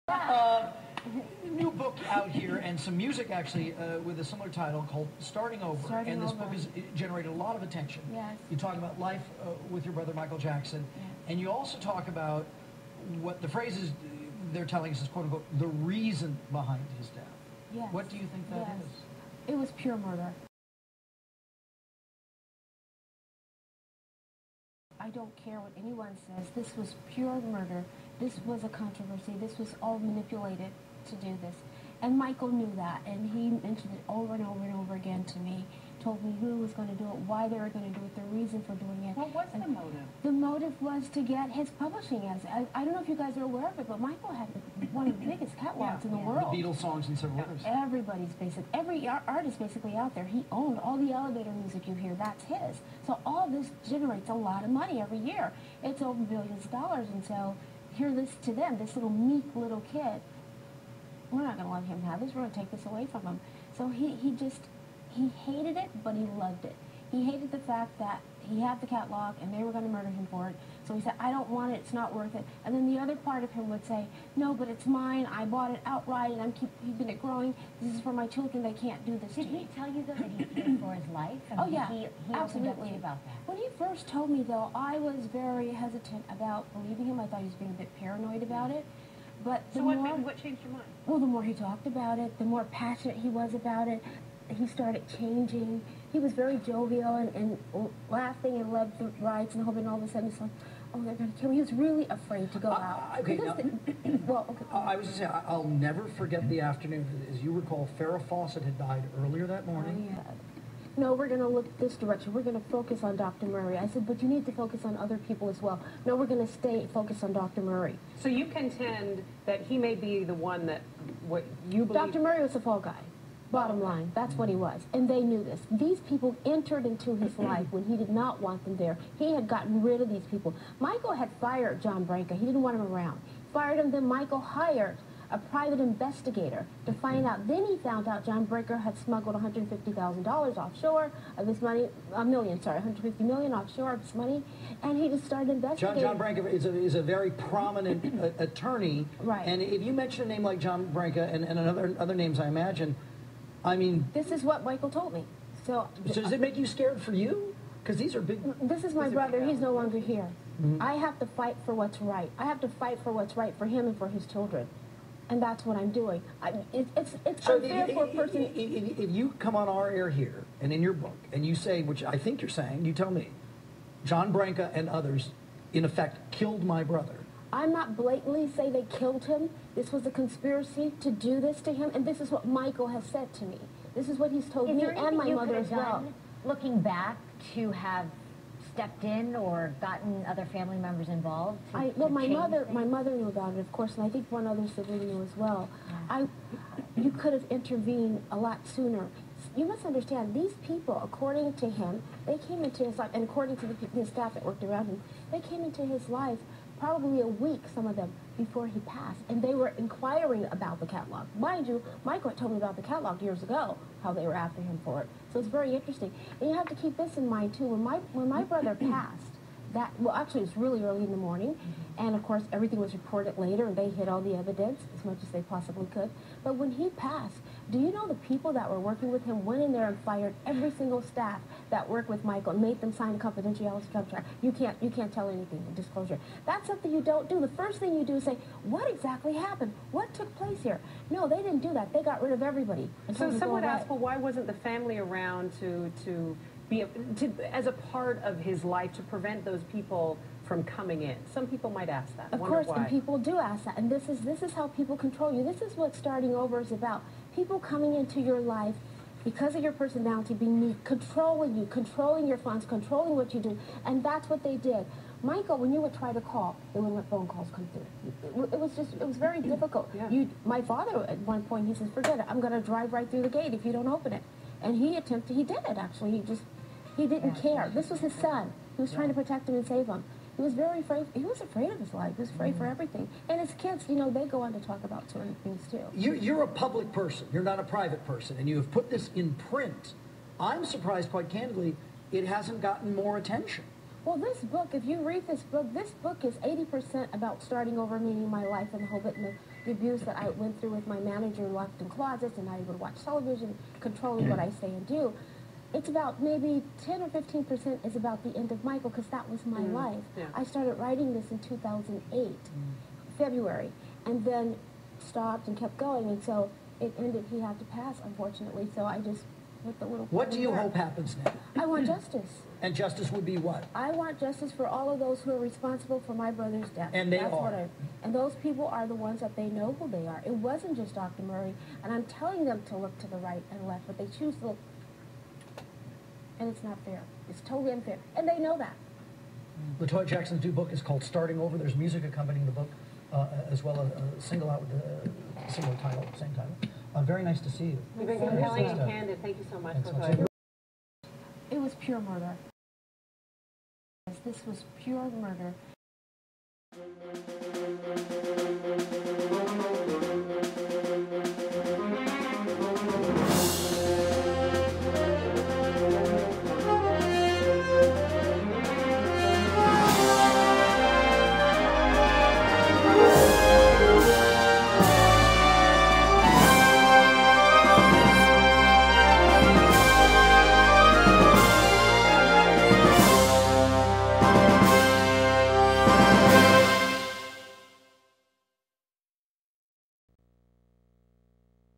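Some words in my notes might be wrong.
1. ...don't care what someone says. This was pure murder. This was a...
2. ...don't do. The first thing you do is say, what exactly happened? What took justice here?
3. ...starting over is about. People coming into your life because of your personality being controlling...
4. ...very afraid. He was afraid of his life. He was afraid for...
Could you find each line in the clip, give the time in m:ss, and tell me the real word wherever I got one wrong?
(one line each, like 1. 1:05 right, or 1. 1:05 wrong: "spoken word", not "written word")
1. 0:25 wrong: "anyone", not "someone"
2. 3:57 wrong: "place", not "justice"
3. 4:15 right
4. 4:40 right.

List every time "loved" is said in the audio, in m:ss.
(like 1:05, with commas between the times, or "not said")
1:06, 1:38.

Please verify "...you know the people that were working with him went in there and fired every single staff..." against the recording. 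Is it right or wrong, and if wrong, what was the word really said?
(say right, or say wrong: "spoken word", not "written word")
right.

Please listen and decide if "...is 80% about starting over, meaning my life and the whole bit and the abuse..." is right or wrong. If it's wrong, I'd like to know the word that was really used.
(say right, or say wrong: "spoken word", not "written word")
right.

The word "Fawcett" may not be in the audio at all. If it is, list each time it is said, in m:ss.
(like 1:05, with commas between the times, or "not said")
1:48.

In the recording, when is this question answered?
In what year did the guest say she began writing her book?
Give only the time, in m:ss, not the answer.
5:11.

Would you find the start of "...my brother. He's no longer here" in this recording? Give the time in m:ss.
2:38.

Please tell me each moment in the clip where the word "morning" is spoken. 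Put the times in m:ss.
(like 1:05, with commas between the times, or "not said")
1:49, 3:41.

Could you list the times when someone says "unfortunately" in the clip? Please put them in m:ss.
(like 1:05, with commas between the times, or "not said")
5:18.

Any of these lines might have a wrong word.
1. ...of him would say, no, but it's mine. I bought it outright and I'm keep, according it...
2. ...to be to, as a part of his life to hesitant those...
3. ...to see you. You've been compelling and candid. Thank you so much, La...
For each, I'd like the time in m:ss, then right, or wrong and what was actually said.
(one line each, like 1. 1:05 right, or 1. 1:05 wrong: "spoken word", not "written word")
1. 1:13 wrong: "keeping", not "according"
2. 4:06 wrong: "prevent", not "hesitant"
3. 5:47 right.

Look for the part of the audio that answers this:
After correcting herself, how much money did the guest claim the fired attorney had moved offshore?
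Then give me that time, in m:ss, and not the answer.
2:22.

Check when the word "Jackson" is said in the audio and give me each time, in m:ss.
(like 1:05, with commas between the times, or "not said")
0:10, 5:40.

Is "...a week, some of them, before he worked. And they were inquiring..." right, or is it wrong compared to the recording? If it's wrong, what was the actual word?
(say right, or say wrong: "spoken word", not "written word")
wrong: "passed", not "worked".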